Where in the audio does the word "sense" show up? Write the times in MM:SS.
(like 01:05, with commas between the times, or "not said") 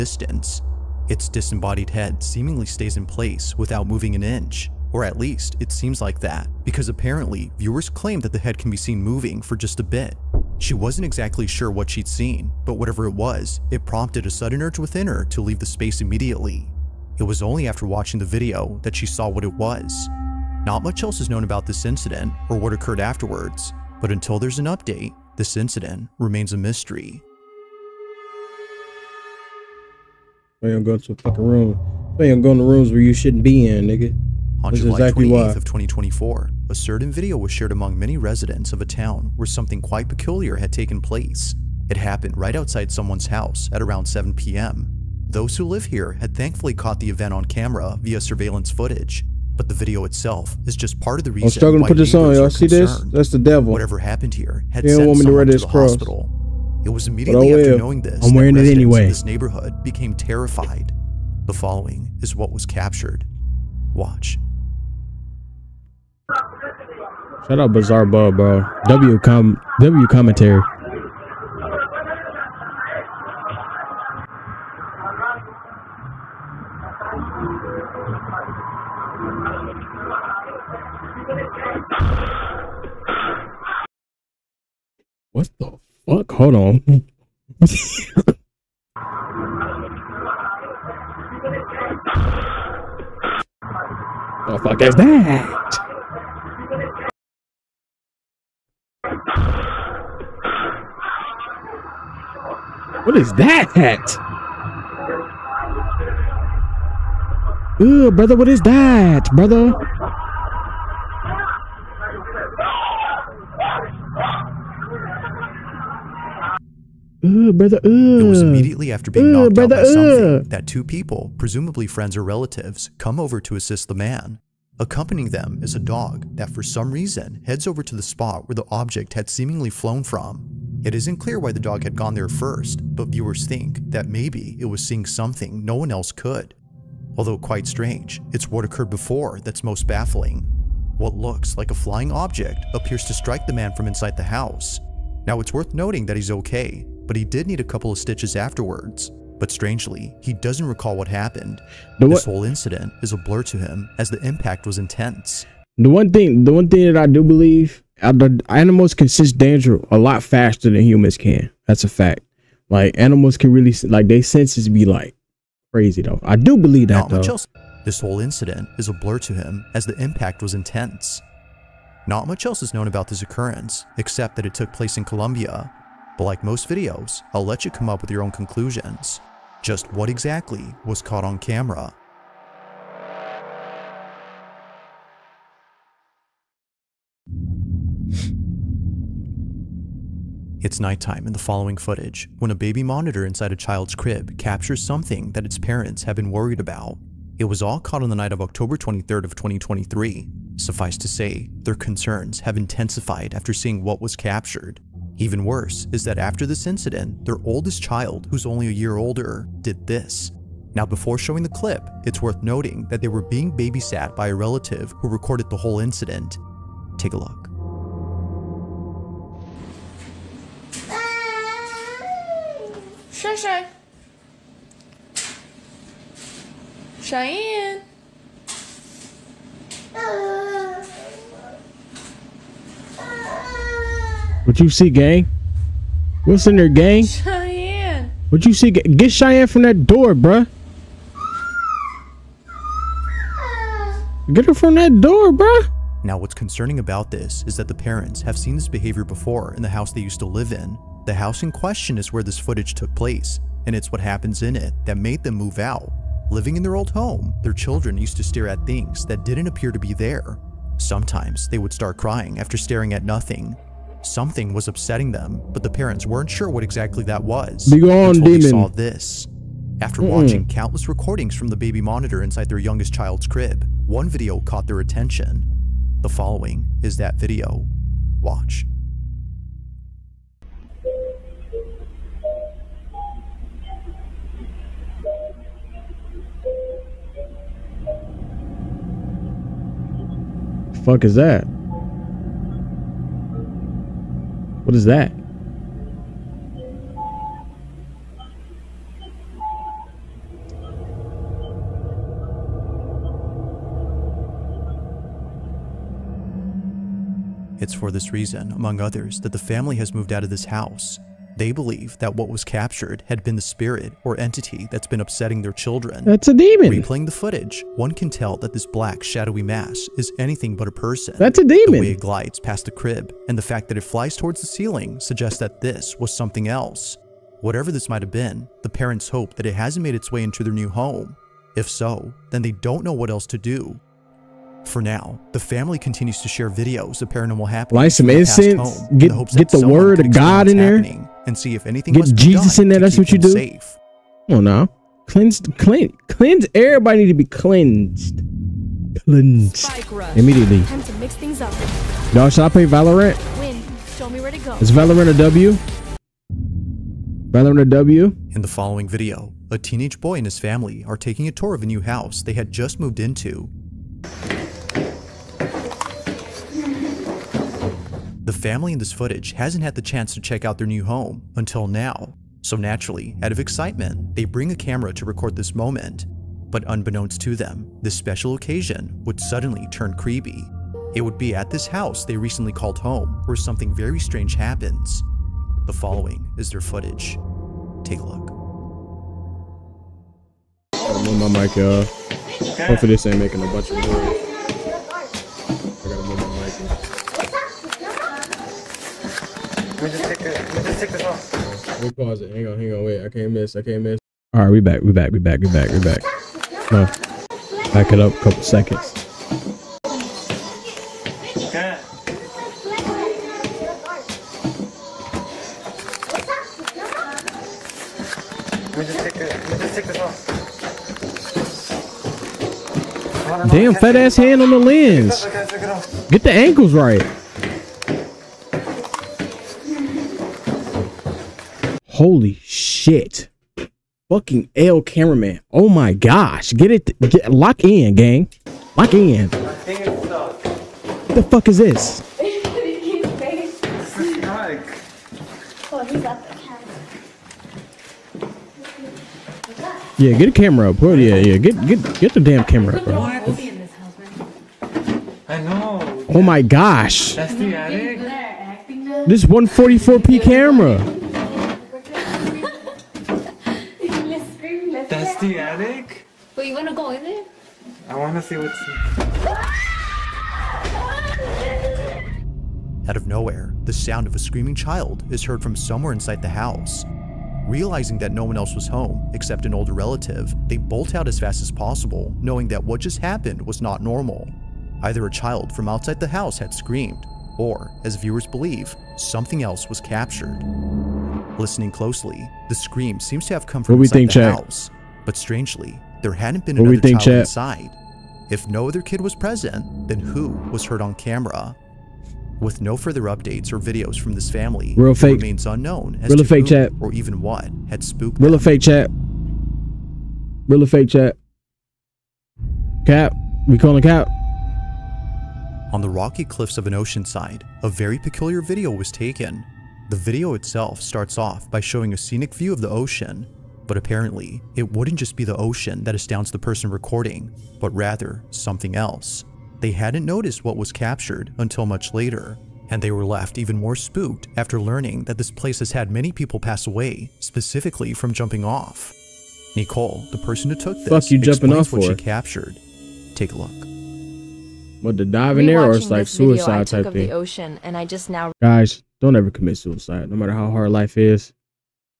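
02:39, 02:44.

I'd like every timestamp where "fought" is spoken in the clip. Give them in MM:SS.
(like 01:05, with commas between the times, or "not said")
not said.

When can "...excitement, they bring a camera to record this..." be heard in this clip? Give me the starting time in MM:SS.
06:13.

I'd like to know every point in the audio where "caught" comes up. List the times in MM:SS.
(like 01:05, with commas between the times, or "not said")
00:46, 03:01, 03:17, 04:34.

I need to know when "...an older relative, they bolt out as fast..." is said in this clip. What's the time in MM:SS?
07:59.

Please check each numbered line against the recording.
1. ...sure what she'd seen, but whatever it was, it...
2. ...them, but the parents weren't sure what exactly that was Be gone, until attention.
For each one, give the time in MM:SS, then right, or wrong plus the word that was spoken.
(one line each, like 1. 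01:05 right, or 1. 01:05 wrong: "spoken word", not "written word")
1. 00:11 right
2. 04:25 wrong: "demon", not "attention".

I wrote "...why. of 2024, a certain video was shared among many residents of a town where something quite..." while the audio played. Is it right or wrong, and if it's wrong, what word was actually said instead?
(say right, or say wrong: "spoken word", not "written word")
right.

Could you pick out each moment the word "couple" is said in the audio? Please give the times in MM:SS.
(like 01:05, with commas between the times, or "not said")
02:27, 06:48.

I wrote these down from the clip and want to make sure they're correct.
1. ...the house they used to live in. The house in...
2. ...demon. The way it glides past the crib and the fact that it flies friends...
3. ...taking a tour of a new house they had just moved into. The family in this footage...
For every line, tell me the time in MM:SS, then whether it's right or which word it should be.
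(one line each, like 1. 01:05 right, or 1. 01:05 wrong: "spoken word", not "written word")
1. 04:09 right
2. 05:21 wrong: "towards", not "friends"
3. 06:00 right.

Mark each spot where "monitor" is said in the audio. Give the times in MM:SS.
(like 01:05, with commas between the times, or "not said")
03:12, 04:31.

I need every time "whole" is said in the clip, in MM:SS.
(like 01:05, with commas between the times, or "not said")
02:32, 02:47, 03:35.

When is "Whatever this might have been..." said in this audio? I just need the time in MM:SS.
05:27.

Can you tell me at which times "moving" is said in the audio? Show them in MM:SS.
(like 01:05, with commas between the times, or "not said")
00:03, 00:09.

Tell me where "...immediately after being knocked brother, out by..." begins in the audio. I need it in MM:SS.
01:58.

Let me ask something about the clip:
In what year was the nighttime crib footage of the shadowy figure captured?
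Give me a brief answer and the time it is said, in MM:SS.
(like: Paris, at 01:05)
2023, at 03:19.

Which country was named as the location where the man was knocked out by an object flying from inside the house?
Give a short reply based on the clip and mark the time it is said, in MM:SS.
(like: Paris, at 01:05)
Colombia, at 02:55.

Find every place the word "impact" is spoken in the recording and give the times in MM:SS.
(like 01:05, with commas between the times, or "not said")
02:34, 02:50.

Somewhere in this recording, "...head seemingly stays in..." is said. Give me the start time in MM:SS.
00:01.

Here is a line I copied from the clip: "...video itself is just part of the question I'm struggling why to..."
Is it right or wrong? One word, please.
wrong.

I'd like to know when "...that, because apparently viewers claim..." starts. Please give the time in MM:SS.
00:06.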